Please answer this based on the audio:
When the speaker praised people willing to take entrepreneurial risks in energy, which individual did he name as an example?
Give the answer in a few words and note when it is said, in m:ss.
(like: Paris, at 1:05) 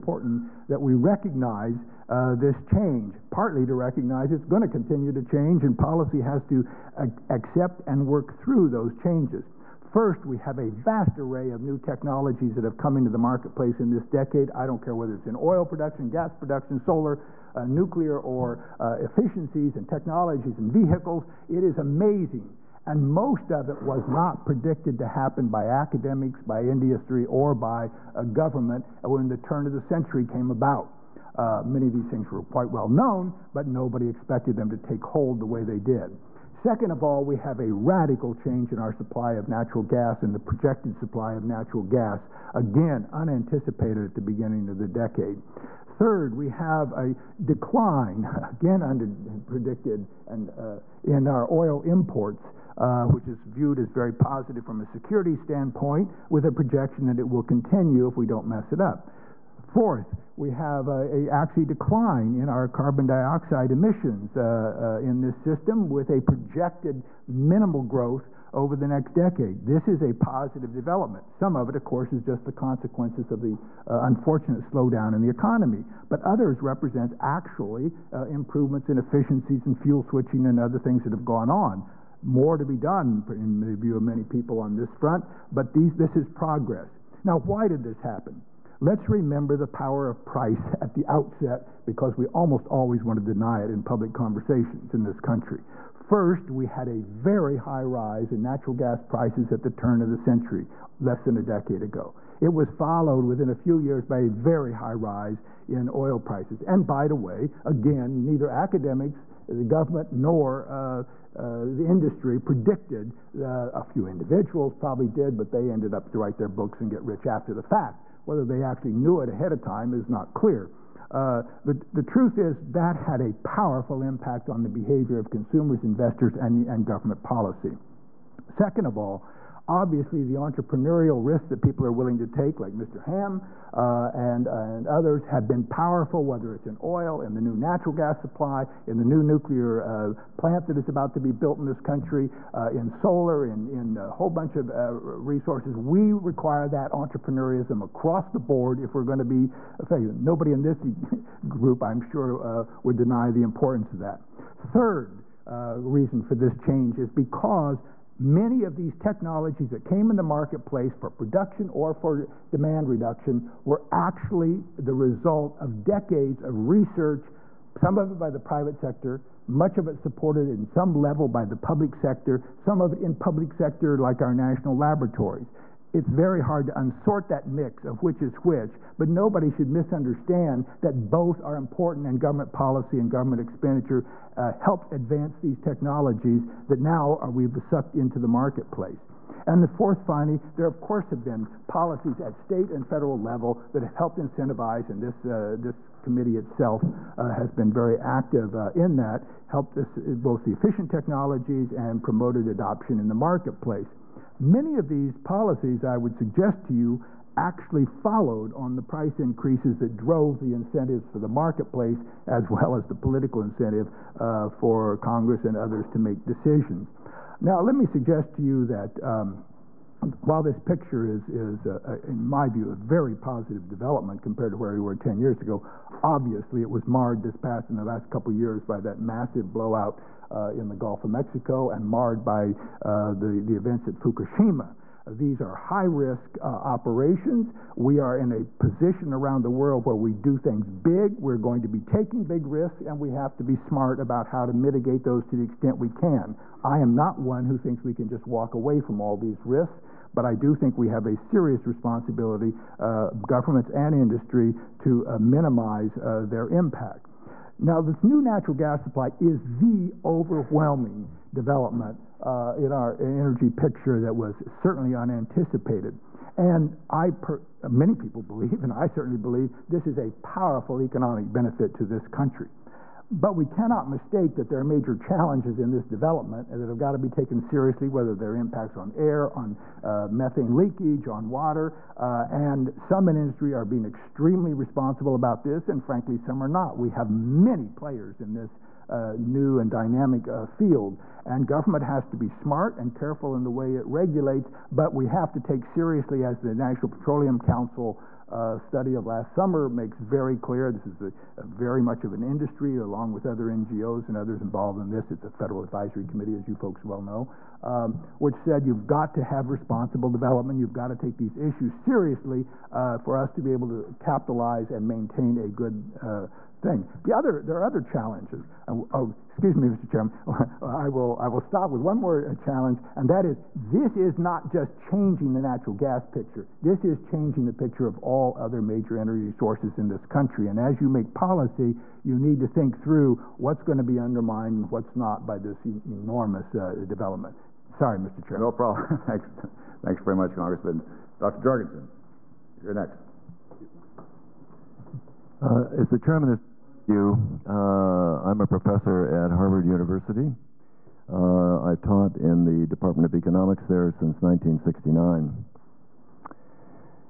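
Mr. Hamm, at 2:12.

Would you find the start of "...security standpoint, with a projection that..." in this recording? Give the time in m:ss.
0:54.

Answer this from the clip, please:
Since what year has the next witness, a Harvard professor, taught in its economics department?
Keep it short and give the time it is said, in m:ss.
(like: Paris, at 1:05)
1969, at 5:54.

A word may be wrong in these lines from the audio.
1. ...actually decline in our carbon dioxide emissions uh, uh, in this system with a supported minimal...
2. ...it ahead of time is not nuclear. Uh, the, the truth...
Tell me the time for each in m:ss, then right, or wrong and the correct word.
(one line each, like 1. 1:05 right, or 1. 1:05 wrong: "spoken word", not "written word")
1. 1:01 wrong: "projected", not "supported"
2. 1:59 wrong: "clear", not "nuclear".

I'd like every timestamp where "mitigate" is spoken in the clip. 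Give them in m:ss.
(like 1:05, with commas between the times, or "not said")
4:04.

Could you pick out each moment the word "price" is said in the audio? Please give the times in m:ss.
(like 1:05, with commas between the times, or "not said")
1:30, 1:39, 1:46, 3:28.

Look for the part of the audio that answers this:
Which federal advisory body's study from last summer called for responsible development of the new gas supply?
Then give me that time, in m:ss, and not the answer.
4:56.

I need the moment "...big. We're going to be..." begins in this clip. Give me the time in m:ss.
4:00.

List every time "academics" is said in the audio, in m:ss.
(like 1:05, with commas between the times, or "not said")
0:25, 1:48.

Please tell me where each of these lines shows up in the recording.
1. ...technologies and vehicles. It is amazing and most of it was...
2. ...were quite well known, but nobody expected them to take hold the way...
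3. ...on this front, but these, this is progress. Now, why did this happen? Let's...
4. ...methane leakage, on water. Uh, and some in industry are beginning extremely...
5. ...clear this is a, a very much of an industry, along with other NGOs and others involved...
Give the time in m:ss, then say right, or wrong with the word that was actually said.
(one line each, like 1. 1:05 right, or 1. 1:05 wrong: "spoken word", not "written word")
1. 0:19 right
2. 0:32 right
3. 1:24 right
4. 4:40 wrong: "being", not "beginning"
5. 5:00 right.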